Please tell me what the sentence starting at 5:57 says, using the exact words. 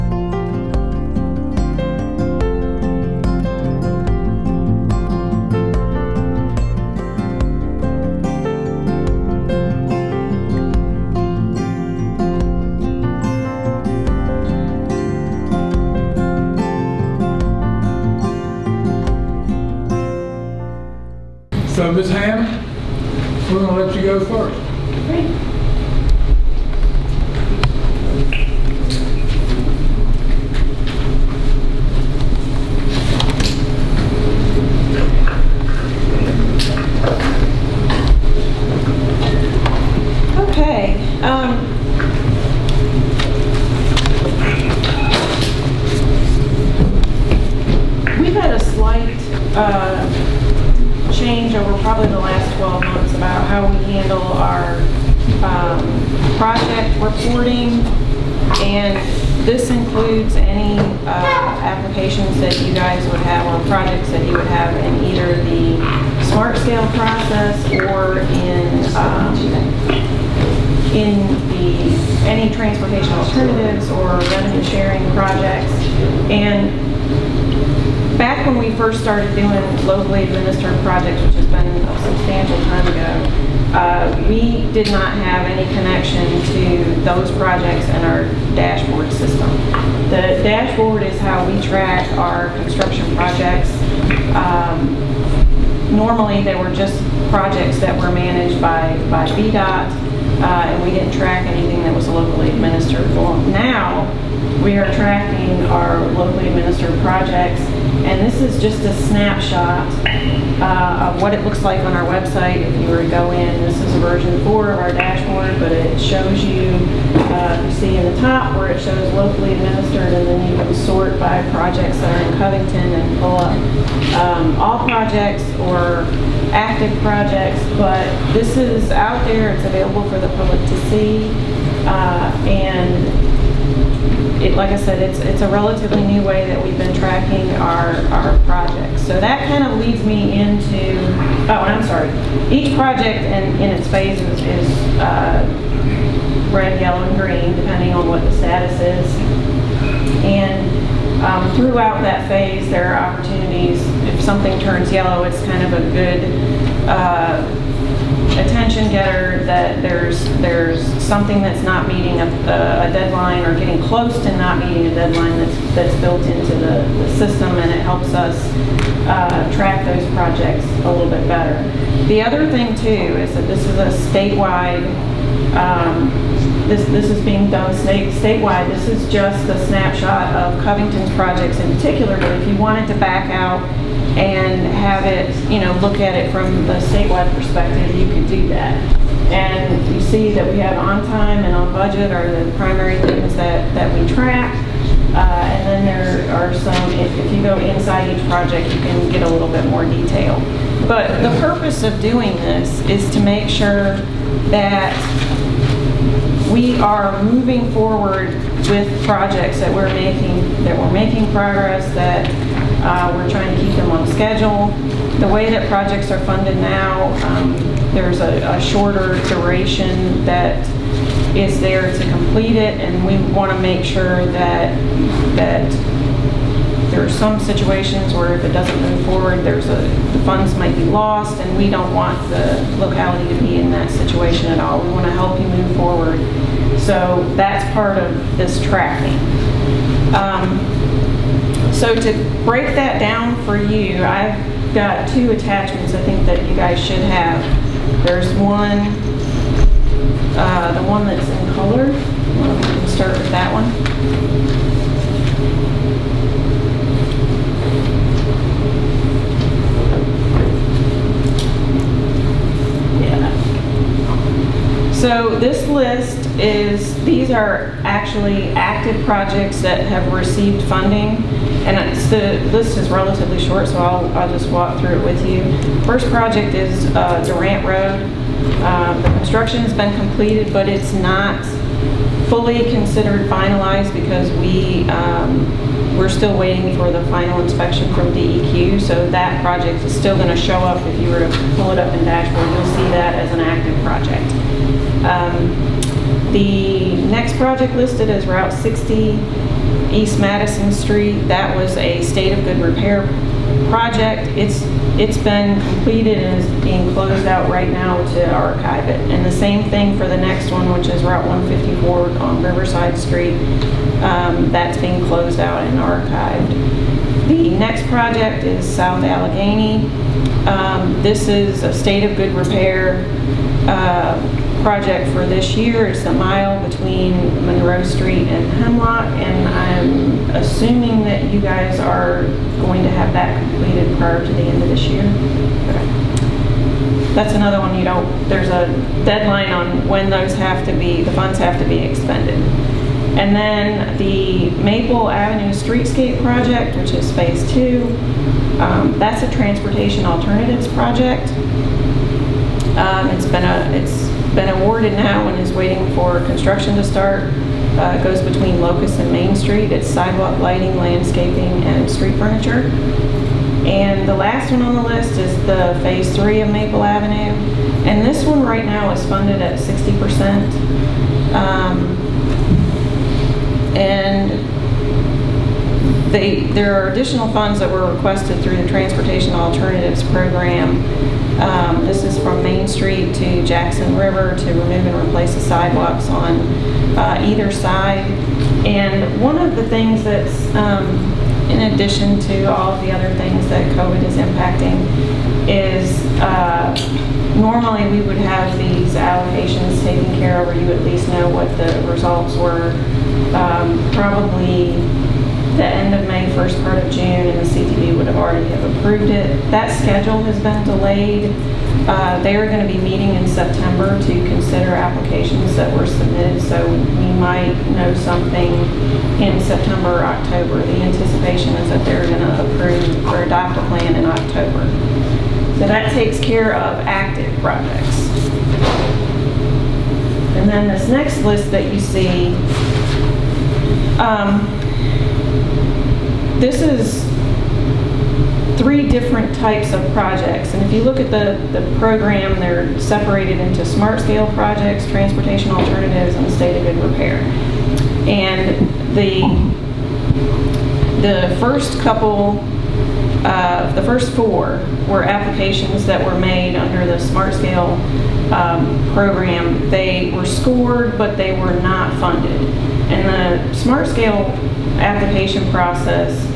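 Uh, goes between Locust and Main Street.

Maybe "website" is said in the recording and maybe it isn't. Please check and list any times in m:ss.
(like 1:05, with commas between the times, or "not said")
1:52.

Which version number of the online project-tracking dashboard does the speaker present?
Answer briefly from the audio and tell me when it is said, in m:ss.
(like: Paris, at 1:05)
4, at 1:53.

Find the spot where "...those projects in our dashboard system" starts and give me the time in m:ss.
1:27.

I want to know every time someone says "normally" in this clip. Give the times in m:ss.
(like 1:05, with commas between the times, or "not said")
1:35, 6:37.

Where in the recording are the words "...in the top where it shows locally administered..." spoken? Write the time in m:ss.
1:57.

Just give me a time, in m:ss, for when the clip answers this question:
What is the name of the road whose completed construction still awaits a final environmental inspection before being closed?
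4:37.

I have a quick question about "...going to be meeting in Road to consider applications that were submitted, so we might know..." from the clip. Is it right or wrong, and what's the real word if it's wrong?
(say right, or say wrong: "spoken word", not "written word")
wrong: "September", not "Road".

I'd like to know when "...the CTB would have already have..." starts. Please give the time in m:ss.
6:47.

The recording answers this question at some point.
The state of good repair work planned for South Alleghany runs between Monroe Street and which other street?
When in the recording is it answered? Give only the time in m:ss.
5:28.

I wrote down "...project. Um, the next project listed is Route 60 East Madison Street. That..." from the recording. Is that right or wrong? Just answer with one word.
right.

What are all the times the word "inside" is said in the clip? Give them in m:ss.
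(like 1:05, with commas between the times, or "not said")
3:17.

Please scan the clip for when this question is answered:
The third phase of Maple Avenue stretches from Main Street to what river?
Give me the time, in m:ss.
6:23.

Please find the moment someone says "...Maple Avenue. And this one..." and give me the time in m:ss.
6:06.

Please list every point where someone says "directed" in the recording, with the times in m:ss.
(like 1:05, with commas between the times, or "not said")
not said.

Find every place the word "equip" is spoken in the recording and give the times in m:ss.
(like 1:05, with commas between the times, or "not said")
not said.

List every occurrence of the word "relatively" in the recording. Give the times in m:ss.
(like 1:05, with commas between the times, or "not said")
2:15, 4:32.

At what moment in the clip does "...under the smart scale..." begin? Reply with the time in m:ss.
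7:36.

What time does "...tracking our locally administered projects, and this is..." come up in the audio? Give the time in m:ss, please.
1:44.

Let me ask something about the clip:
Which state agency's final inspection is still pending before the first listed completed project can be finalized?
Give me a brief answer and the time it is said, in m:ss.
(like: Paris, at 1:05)
DEQ, at 4:48.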